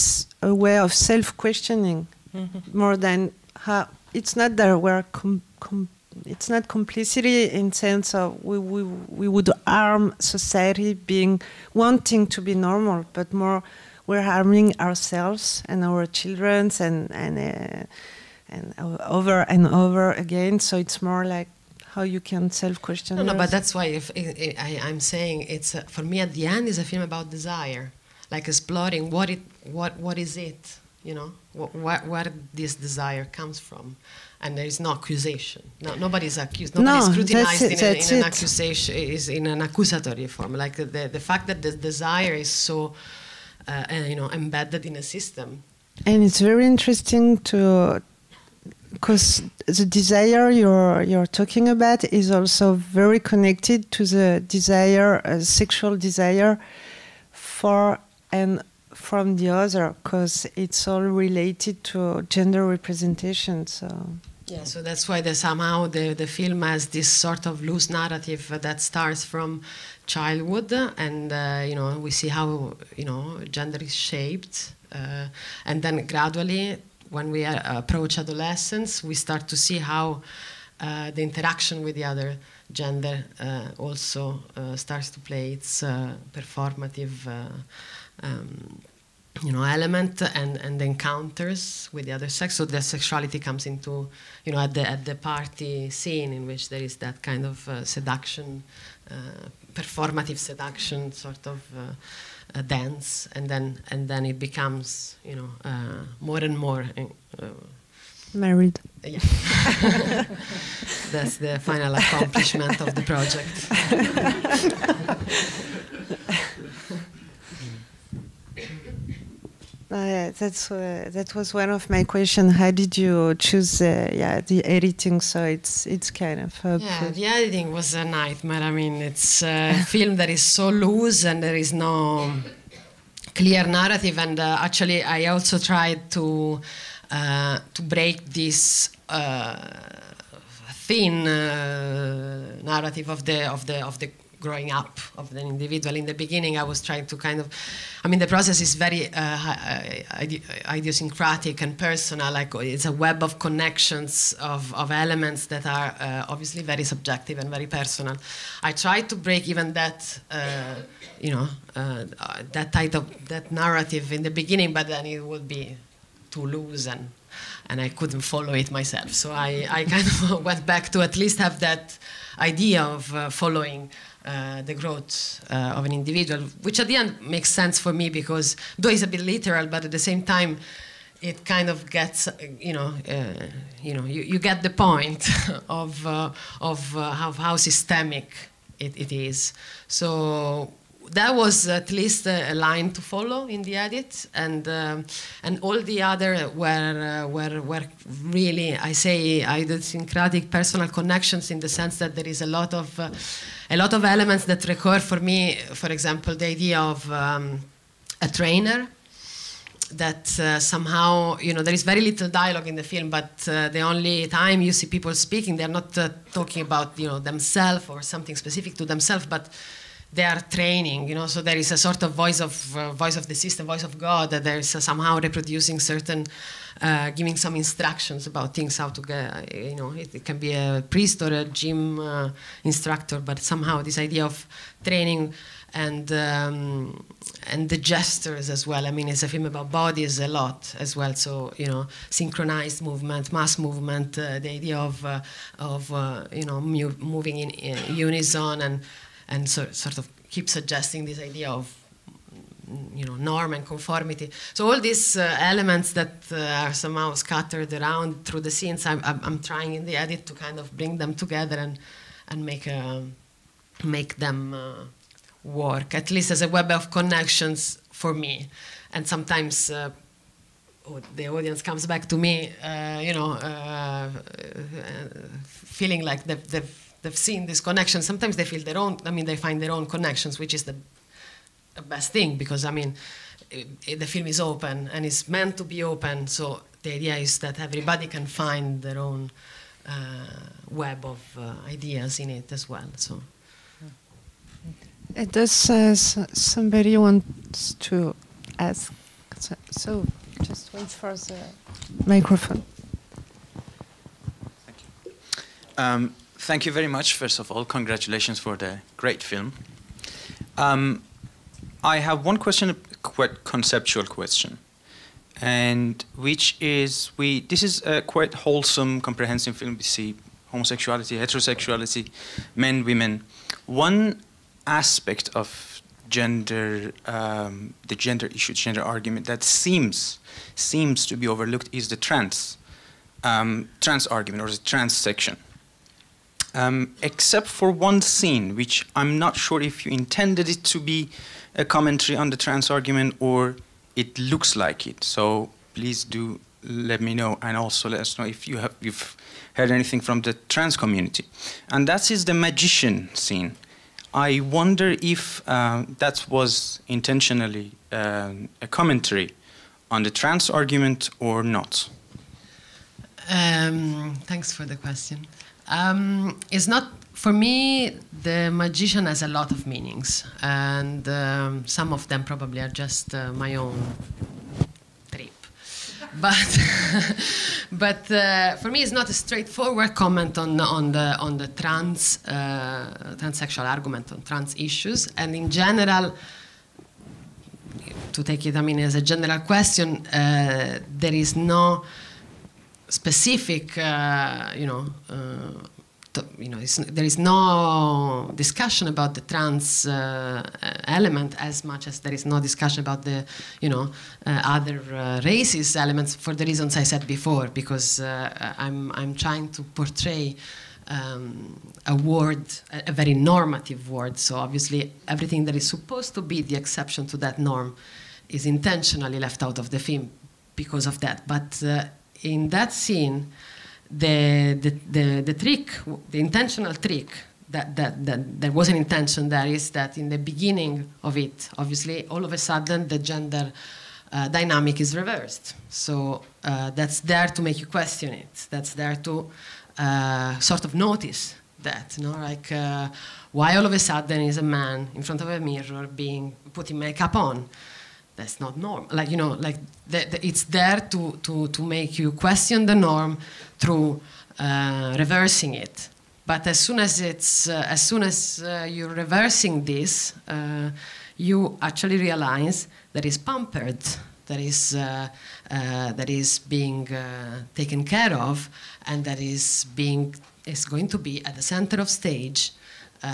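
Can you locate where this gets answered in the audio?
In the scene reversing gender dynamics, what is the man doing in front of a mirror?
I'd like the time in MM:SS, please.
07:26.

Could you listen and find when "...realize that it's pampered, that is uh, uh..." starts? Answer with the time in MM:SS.
07:41.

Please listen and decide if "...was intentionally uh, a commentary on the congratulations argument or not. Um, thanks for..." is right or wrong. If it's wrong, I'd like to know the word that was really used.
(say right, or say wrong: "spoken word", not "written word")
wrong: "trans", not "congratulations".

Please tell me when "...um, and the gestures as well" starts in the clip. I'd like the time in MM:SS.
03:56.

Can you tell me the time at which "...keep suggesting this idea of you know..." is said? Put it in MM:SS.
04:10.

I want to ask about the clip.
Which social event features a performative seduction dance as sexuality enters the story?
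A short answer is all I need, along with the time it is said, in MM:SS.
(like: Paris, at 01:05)
The party scene, at 01:35.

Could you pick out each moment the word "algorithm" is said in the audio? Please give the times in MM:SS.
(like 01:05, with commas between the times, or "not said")
not said.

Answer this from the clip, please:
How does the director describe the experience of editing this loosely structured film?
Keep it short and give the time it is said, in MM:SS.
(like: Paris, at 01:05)
A nightmare, at 02:07.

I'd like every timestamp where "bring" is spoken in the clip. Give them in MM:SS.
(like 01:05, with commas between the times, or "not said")
04:20.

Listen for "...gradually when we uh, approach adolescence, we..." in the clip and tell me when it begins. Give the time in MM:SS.
01:16.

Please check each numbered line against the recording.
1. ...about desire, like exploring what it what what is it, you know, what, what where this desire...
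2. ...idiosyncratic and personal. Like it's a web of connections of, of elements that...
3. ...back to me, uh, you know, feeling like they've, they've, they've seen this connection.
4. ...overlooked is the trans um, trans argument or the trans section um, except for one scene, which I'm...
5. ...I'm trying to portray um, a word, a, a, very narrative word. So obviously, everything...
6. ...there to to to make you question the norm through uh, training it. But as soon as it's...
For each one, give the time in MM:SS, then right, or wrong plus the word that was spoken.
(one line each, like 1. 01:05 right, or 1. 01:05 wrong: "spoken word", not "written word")
1. 00:27 right
2. 02:30 right
3. 04:31 right
4. 05:31 right
5. 06:48 wrong: "normative", not "narrative"
6. 07:30 wrong: "reversing", not "training".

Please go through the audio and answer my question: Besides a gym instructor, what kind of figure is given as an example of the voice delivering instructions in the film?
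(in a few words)
A priest.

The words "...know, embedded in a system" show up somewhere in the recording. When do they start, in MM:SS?
00:44.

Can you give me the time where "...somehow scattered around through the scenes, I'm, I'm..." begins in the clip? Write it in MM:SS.
04:16.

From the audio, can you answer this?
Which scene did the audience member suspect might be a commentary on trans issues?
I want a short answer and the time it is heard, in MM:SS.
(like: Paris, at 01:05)
The magician scene, at 05:52.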